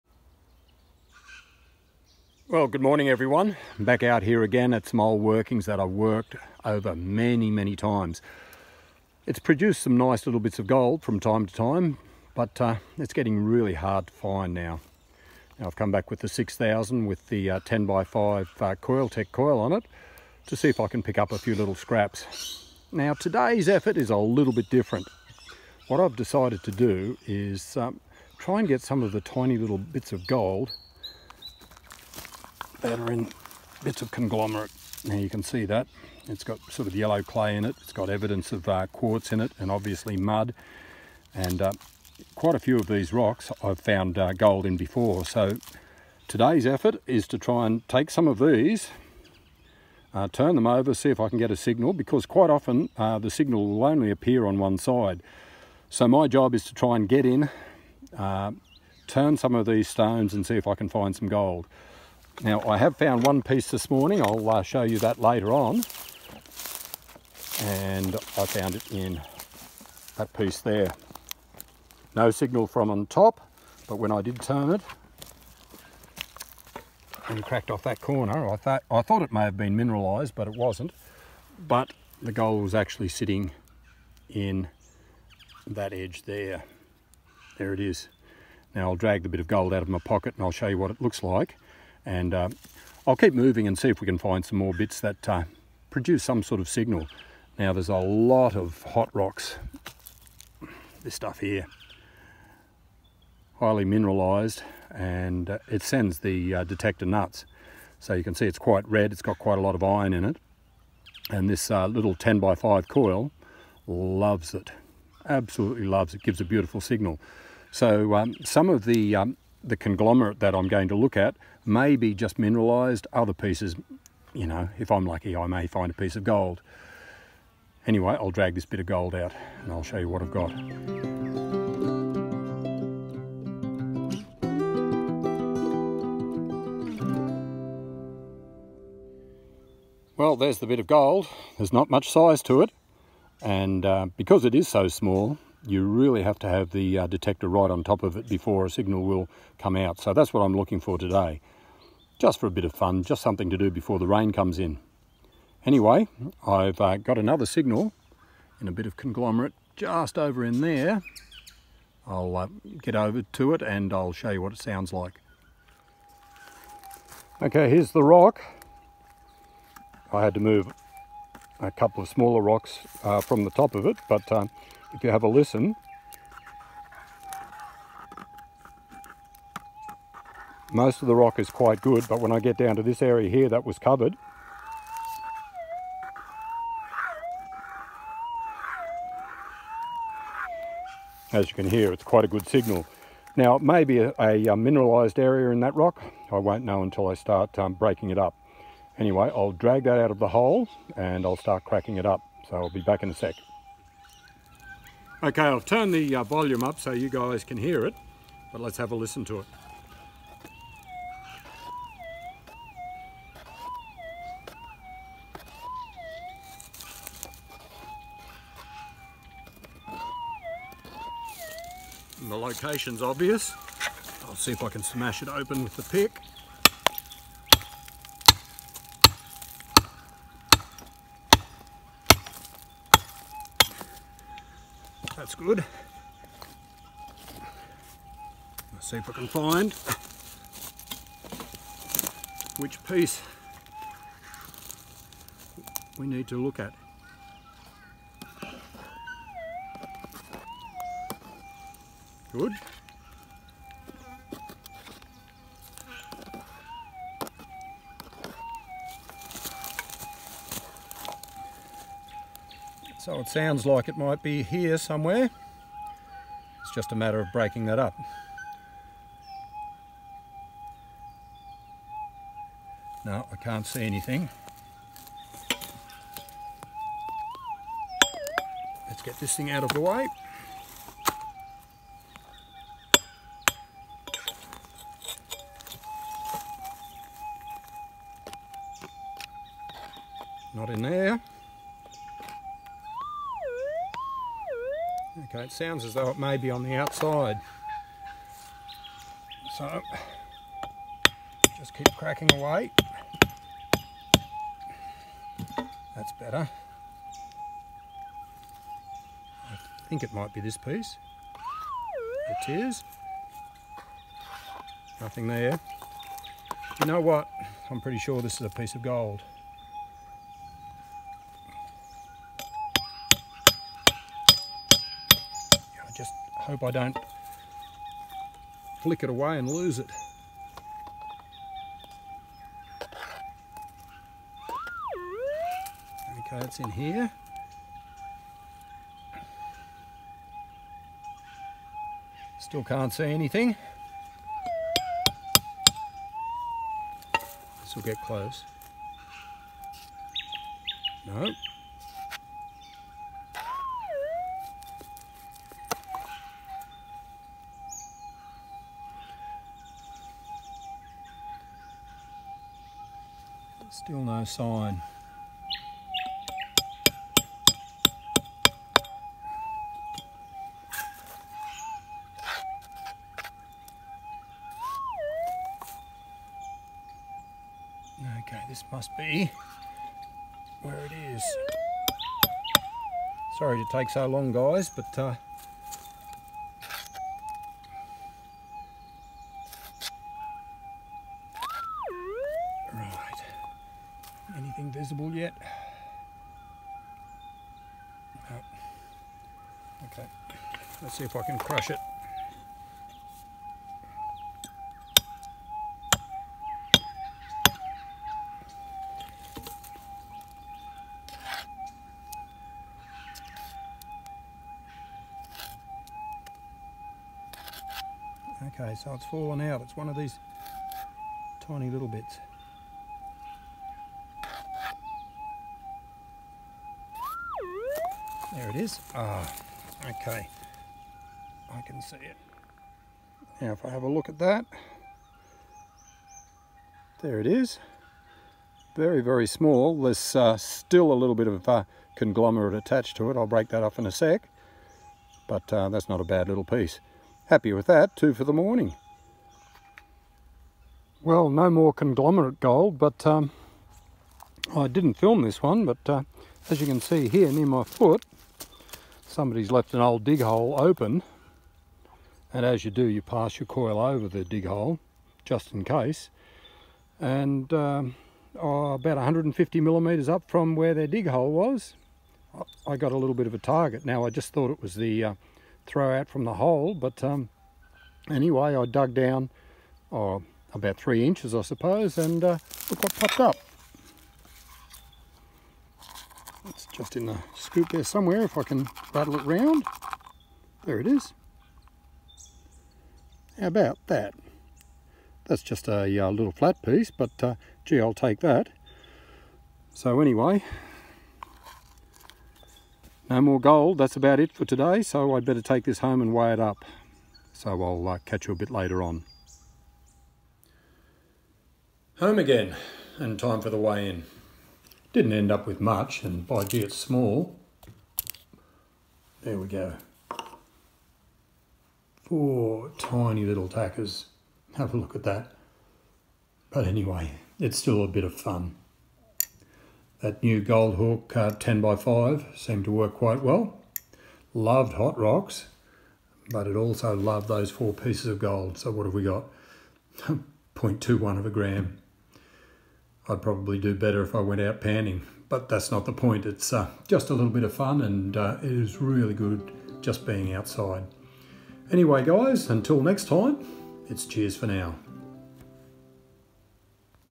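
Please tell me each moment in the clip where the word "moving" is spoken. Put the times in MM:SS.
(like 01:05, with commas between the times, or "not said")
01:33.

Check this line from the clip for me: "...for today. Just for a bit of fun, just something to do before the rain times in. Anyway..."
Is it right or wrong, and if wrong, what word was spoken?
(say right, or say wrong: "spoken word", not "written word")
wrong: "comes", not "times".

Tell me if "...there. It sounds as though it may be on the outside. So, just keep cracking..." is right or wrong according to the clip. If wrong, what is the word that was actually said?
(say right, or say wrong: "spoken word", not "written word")
right.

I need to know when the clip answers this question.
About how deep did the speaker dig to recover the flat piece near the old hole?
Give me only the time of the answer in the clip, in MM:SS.
08:00.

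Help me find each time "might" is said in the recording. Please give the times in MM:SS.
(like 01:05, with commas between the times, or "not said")
04:23, 05:10.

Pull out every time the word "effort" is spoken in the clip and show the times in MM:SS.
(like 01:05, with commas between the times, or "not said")
00:23, 00:46.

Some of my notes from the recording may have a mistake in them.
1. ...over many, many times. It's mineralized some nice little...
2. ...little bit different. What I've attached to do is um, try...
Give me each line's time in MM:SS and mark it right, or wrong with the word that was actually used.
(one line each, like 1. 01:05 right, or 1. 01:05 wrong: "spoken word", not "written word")
1. 00:06 wrong: "produced", not "mineralized"
2. 00:24 wrong: "decided", not "attached".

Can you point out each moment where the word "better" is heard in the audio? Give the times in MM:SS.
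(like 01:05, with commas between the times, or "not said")
05:06, 08:25, 09:03.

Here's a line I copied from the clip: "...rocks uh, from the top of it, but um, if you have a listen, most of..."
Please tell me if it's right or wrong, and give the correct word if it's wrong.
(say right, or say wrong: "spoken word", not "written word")
right.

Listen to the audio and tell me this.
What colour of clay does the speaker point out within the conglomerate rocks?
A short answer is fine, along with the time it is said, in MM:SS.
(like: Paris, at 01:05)
Yellow, at 00:36.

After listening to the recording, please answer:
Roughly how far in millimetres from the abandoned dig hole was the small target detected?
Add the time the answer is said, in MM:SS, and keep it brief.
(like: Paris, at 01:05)
150 millimeters, at 07:48.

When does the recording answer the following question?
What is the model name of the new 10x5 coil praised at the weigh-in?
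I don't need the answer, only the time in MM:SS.
08:50.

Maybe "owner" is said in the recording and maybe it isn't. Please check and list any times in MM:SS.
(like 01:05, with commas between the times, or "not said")
not said.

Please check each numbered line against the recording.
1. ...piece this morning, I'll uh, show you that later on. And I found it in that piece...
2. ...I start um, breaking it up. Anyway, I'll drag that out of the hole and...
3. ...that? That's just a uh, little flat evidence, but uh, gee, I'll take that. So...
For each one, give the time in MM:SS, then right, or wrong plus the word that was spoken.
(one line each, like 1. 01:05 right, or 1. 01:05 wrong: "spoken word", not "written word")
1. 01:03 right
2. 03:17 right
3. 08:13 wrong: "piece", not "evidence".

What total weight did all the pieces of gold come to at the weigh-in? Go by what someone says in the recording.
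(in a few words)
0.21 gram.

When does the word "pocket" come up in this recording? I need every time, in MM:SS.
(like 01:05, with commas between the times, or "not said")
01:29.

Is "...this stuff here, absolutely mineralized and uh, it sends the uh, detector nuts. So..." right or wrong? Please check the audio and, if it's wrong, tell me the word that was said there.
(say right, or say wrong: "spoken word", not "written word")
wrong: "highly", not "absolutely".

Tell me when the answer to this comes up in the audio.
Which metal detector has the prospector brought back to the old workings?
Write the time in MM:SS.
00:16.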